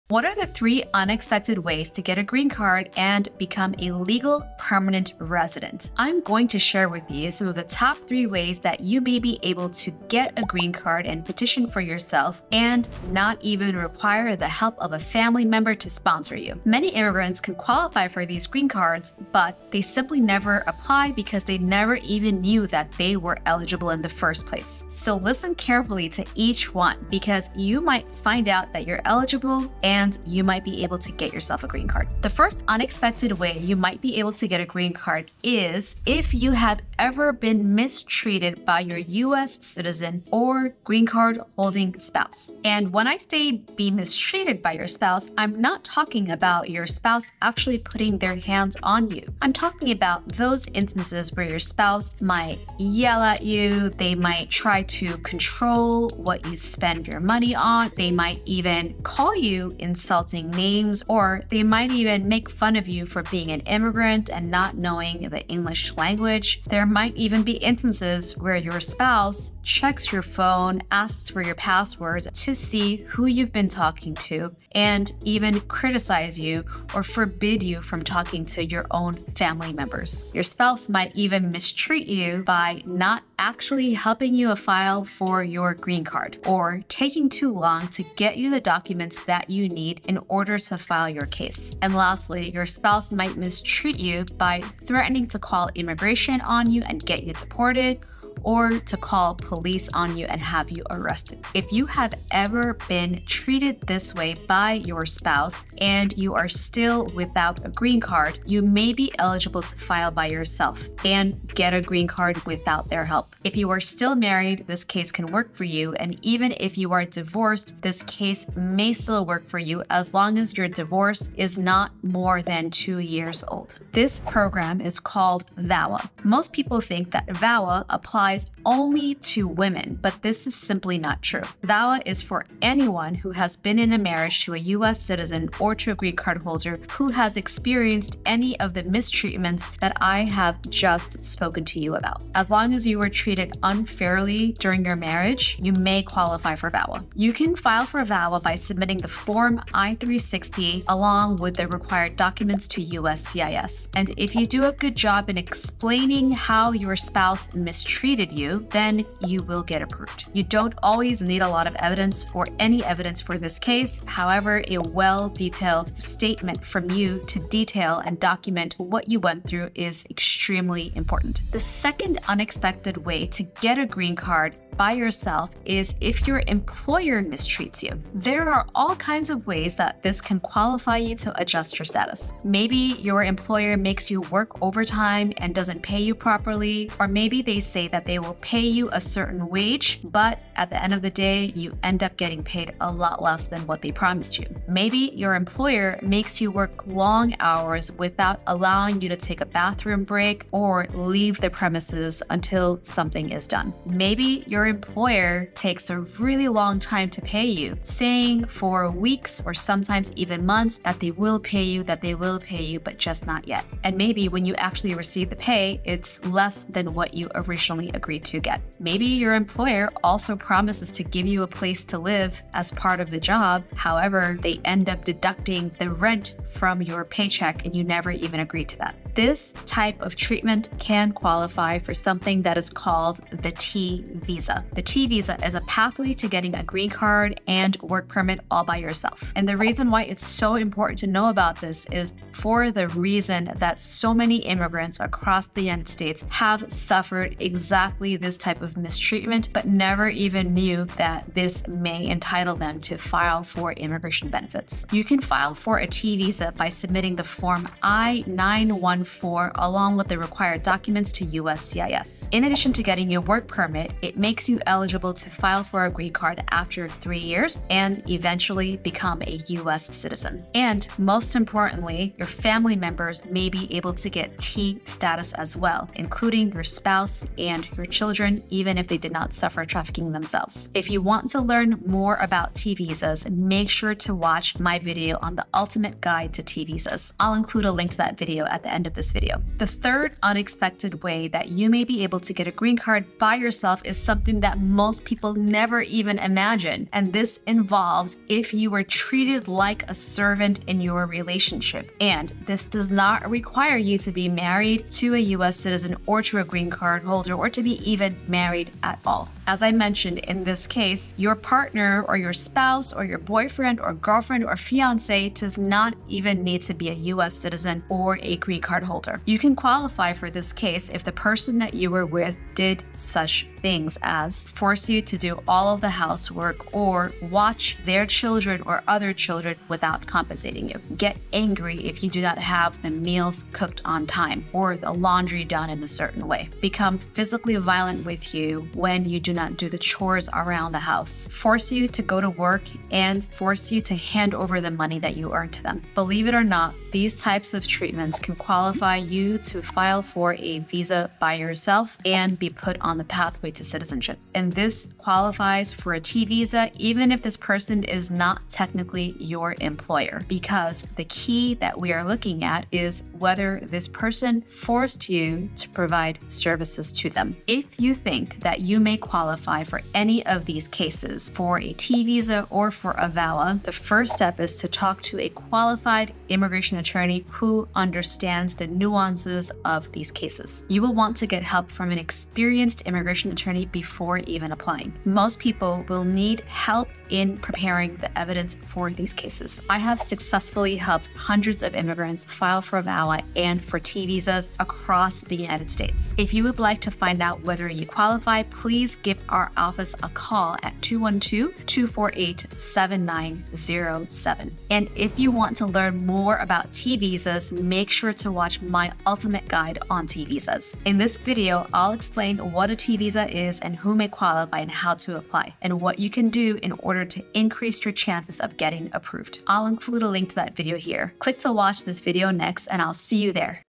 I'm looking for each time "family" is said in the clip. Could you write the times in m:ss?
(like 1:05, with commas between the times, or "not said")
0:14, 1:19, 4:32.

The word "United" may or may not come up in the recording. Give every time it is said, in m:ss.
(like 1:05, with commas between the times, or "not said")
4:05, 6:35.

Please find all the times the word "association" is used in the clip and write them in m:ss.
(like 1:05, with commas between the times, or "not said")
not said.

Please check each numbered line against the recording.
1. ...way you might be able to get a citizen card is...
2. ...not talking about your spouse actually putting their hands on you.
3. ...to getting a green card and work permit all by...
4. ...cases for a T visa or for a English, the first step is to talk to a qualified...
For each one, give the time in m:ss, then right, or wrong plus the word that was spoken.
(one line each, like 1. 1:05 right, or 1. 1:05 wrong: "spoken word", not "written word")
1. 0:33 wrong: "green", not "citizen"
2. 0:45 right
3. 3:56 right
4. 6:10 wrong: "VAWA", not "English".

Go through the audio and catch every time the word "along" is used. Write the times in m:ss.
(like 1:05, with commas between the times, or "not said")
2:30, 4:19.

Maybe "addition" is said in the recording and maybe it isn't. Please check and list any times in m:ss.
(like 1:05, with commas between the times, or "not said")
4:22.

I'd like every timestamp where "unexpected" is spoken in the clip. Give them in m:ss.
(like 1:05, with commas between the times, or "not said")
0:00, 0:32, 2:52, 4:50.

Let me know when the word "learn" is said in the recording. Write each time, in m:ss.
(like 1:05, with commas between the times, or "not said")
4:41, 6:45.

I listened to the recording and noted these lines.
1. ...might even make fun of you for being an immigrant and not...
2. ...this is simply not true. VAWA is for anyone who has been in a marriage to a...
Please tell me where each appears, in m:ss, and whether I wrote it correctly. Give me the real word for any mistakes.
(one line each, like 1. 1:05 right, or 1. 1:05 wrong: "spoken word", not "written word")
1. 1:01 right
2. 2:10 right.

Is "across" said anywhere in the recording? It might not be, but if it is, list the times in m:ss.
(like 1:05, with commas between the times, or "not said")
4:05, 6:34.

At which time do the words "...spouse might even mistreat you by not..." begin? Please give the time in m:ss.
1:20.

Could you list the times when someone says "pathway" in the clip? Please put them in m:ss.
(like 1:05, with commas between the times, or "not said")
3:55, 5:53.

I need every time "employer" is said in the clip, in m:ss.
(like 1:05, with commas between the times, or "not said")
2:56, 3:03, 3:15, 3:24, 3:39, 5:59.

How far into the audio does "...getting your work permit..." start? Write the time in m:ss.
4:22.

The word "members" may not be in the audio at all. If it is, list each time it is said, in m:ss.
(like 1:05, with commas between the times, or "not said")
0:15, 1:19, 4:32.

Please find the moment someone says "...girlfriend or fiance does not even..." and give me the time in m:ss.
5:13.